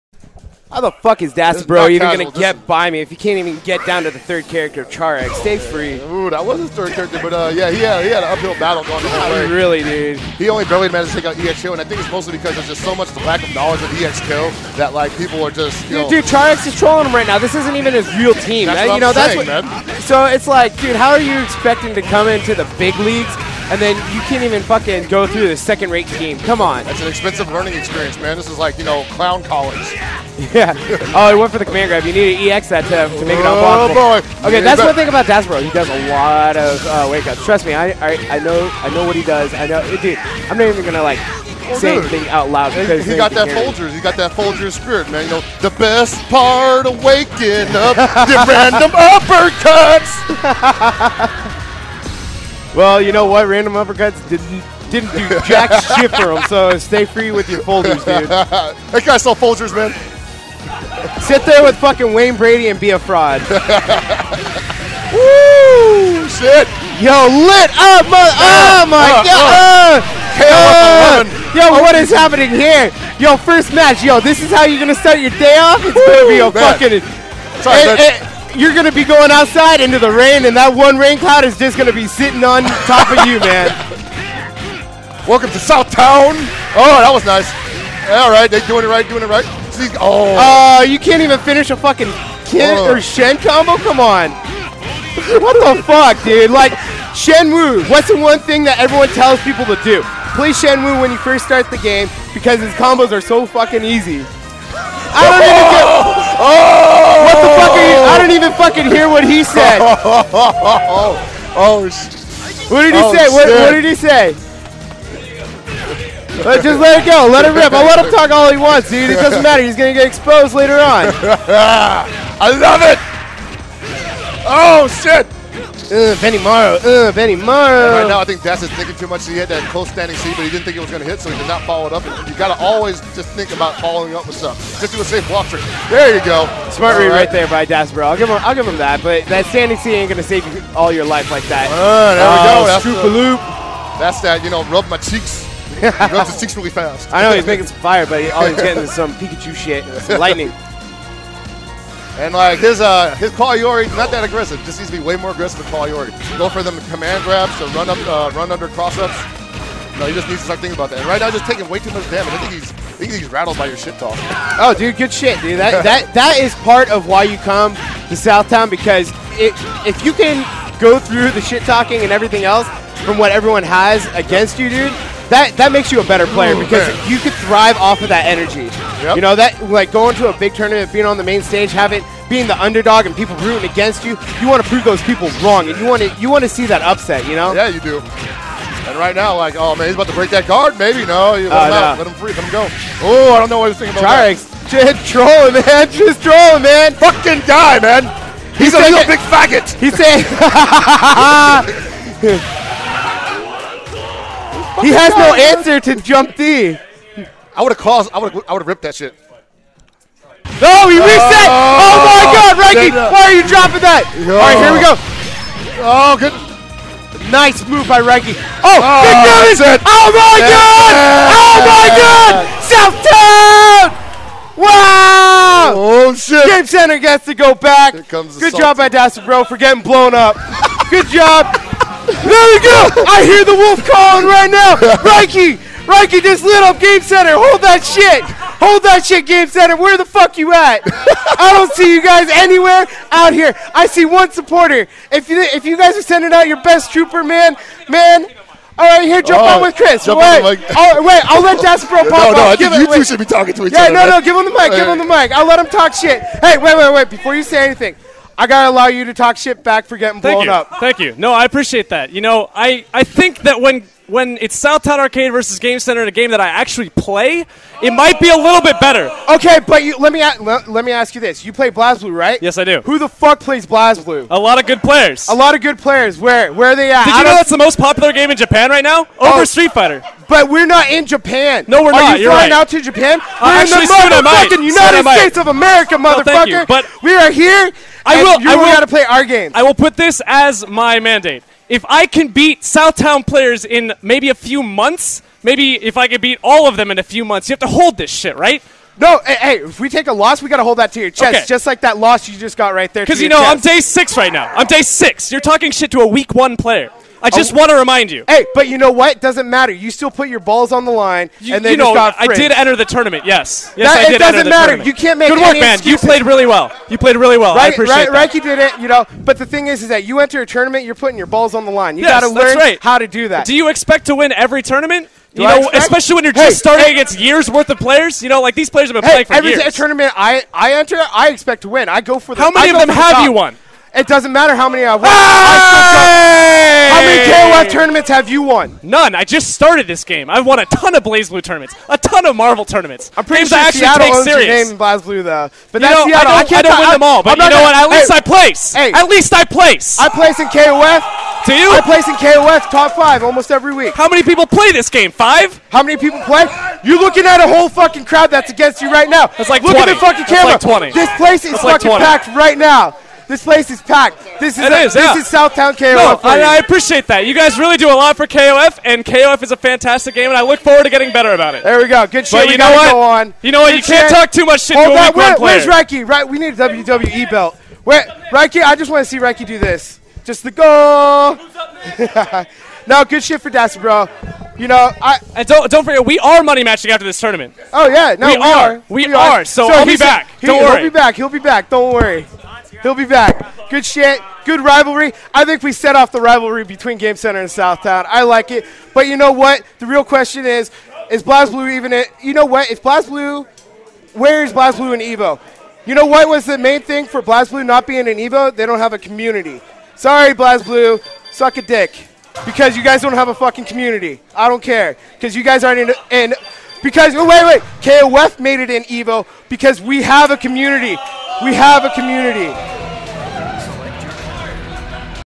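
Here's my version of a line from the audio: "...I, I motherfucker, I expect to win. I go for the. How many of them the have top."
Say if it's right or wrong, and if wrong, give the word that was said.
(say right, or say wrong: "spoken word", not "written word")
wrong: "enter", not "motherfucker".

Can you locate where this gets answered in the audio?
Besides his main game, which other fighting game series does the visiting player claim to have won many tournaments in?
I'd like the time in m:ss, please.
5:42.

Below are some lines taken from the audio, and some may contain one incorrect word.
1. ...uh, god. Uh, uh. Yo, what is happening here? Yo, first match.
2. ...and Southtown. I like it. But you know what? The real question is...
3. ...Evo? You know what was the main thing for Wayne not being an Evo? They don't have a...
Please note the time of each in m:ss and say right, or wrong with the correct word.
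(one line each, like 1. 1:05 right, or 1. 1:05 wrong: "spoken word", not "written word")
1. 1:09 right
2. 6:37 right
3. 6:45 wrong: "BlazBlue", not "Wayne".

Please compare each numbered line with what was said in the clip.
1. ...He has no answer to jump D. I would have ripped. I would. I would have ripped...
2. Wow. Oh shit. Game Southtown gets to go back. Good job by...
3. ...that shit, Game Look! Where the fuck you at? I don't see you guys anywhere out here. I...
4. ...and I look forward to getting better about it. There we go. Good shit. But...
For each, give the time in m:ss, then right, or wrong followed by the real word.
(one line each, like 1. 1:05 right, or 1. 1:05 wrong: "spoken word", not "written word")
1. 3:24 wrong: "caused", not "ripped"
2. 3:44 wrong: "Center", not "Southtown"
3. 3:58 wrong: "Center", not "Look"
4. 6:10 right.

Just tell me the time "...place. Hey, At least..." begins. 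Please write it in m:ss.
5:48.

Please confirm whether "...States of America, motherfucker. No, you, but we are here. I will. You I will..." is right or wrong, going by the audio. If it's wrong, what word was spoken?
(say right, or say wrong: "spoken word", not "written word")
right.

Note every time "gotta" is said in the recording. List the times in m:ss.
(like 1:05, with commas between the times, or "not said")
4:18, 4:48.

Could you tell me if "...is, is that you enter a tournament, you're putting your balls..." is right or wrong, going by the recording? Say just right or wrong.
right.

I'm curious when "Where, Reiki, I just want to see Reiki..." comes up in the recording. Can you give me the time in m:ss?
6:17.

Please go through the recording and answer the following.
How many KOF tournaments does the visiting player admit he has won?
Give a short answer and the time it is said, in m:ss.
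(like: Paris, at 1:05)
None, at 5:38.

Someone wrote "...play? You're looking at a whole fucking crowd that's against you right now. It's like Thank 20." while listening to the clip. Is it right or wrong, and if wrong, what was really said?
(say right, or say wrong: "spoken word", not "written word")
wrong: "Look", not "Thank".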